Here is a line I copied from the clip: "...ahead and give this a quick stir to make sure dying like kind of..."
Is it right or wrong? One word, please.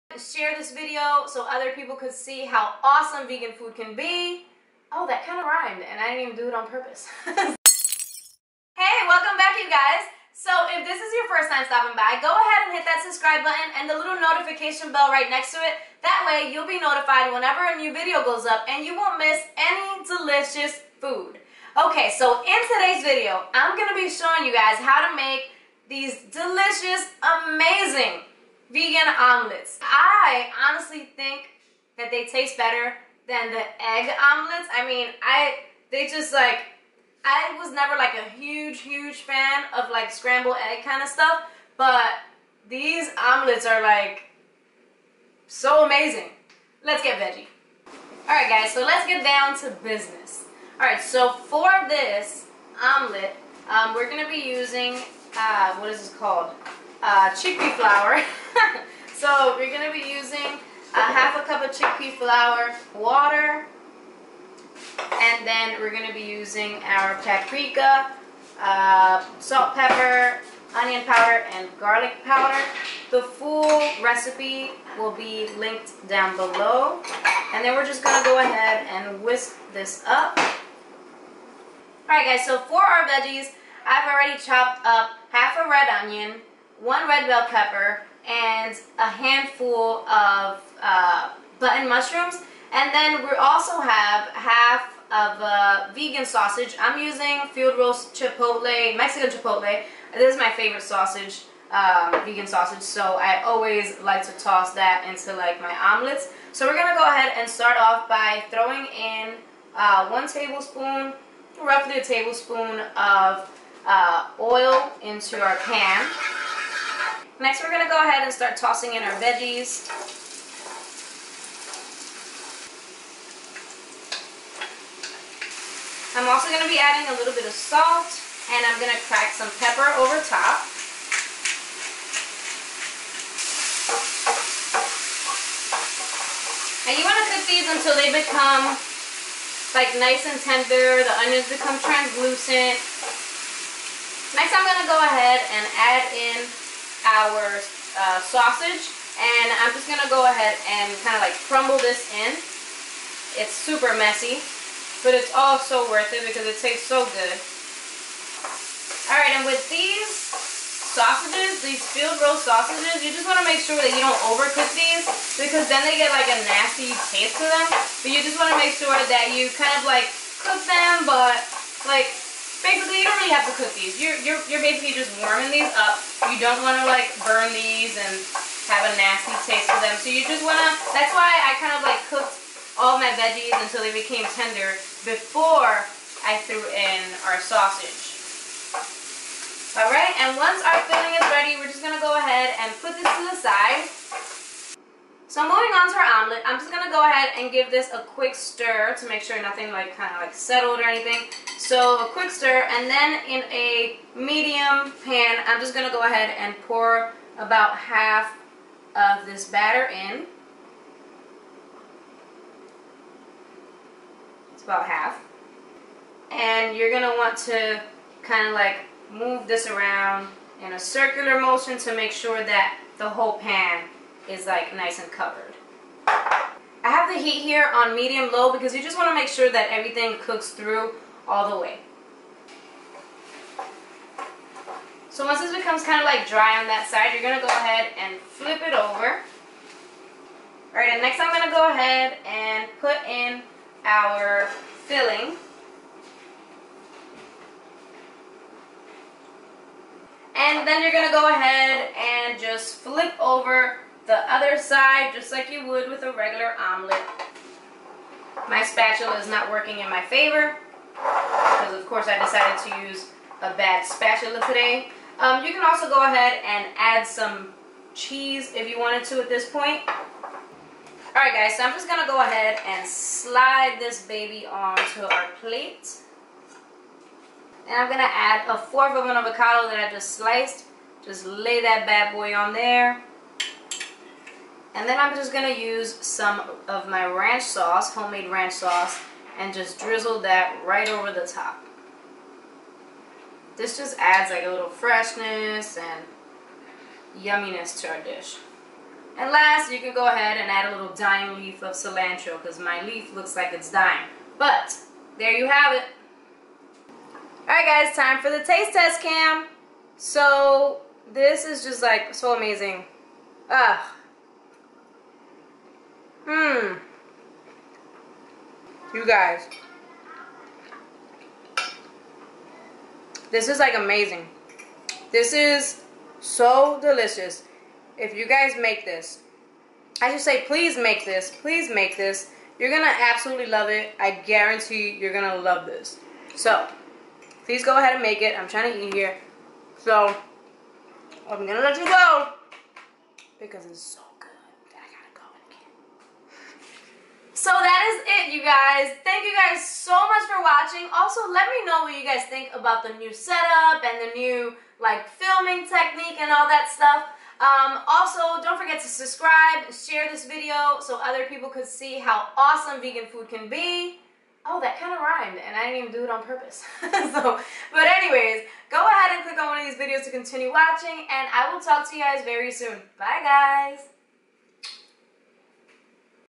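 wrong.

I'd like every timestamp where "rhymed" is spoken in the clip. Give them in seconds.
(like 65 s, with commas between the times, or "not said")
5 s, 365 s.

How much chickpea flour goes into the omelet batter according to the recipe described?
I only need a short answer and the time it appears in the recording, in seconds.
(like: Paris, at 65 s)
half a cup, at 60 s.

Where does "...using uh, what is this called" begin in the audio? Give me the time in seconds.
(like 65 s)
54 s.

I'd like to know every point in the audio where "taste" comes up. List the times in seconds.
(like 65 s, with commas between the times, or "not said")
32 s, 156 s, 167 s, 179 s, 308 s.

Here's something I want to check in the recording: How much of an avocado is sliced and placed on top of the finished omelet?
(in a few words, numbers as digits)
a fourth.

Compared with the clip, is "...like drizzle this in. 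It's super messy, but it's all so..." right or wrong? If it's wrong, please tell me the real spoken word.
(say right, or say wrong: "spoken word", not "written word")
wrong: "crumble", not "drizzle".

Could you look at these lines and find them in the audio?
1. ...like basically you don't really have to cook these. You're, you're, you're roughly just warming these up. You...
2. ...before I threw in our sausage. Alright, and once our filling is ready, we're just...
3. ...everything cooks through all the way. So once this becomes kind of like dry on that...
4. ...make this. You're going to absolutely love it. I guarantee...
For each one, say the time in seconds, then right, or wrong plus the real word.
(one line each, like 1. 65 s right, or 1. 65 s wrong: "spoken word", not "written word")
1. 171 s wrong: "basically", not "roughly"
2. 185 s right
3. 229 s right
4. 331 s right.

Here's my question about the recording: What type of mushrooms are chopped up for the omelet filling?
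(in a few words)
button mushrooms.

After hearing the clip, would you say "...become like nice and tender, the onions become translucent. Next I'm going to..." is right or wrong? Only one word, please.
right.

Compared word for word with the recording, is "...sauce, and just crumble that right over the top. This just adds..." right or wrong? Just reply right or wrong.
wrong.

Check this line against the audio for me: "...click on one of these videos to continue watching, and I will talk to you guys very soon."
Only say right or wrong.
right.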